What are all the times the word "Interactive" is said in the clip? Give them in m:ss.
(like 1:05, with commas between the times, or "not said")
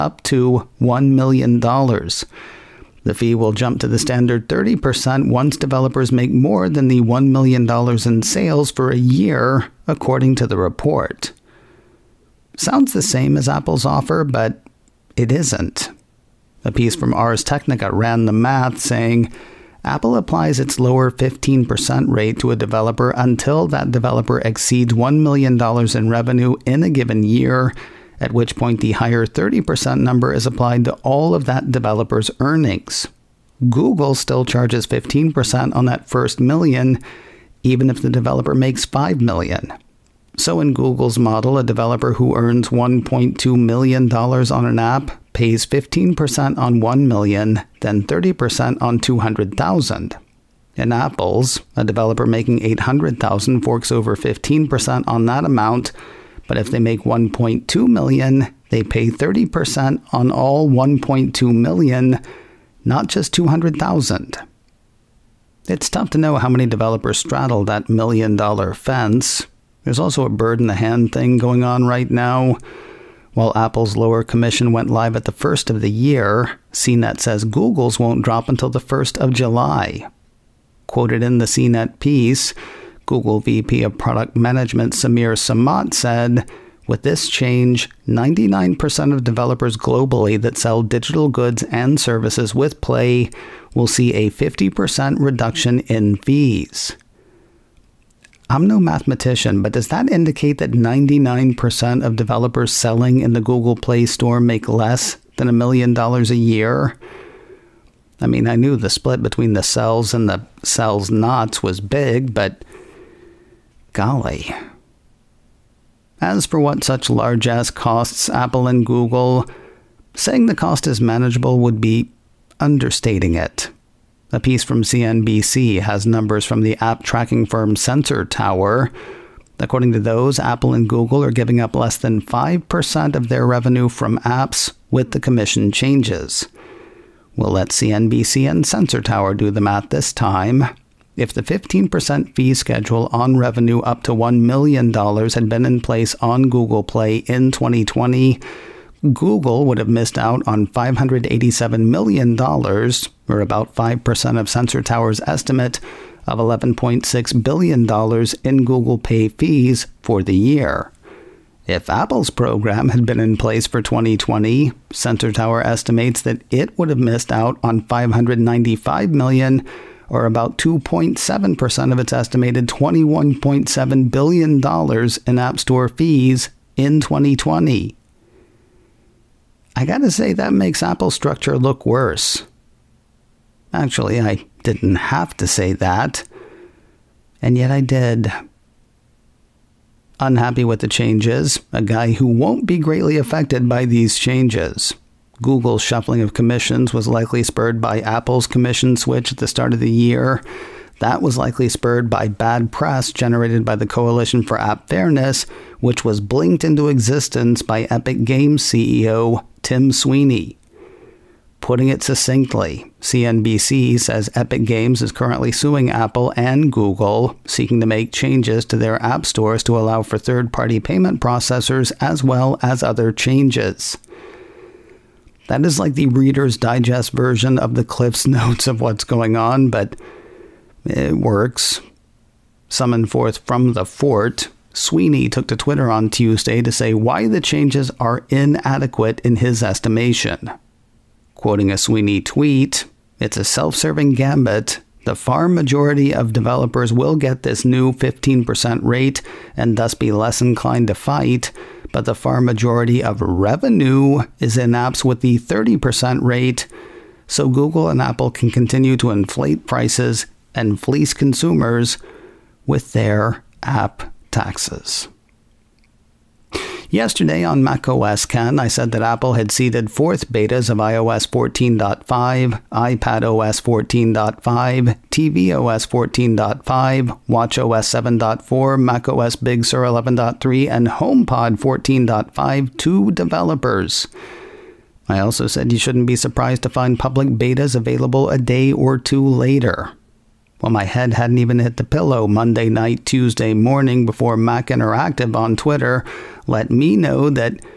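4:54.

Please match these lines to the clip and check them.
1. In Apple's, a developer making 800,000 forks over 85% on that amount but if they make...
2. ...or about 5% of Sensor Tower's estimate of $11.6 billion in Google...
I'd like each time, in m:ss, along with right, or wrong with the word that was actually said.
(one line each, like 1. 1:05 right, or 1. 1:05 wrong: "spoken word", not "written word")
1. 0:50 wrong: "15", not "85"
2. 2:32 right.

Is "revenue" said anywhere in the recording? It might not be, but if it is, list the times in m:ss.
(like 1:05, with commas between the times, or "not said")
0:26, 2:13, 2:23, 4:13.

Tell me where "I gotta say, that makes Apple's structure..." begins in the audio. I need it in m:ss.
2:59.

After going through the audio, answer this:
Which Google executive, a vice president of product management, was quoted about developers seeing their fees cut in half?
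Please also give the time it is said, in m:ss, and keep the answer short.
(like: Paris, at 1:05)
Samir Samat, at 1:24.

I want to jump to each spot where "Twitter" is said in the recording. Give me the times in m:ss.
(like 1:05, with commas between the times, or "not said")
3:55, 4:55.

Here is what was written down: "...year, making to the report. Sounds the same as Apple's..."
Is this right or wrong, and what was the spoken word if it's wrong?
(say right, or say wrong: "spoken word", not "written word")
wrong: "according", not "making".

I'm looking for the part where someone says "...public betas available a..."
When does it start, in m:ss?
4:46.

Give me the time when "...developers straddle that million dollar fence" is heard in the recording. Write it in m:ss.
1:06.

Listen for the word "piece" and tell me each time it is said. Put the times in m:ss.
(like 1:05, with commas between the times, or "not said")
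0:16, 1:21, 2:04.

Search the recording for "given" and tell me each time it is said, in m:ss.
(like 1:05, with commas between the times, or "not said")
0:26.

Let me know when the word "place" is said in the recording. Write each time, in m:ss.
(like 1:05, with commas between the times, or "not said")
2:25, 2:43.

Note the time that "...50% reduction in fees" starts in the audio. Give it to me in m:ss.
1:34.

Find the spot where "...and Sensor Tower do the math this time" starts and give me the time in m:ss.
2:18.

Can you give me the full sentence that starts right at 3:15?
Google's shuffling of commissions was likely spurred by Apple's commission switch at the start of the year.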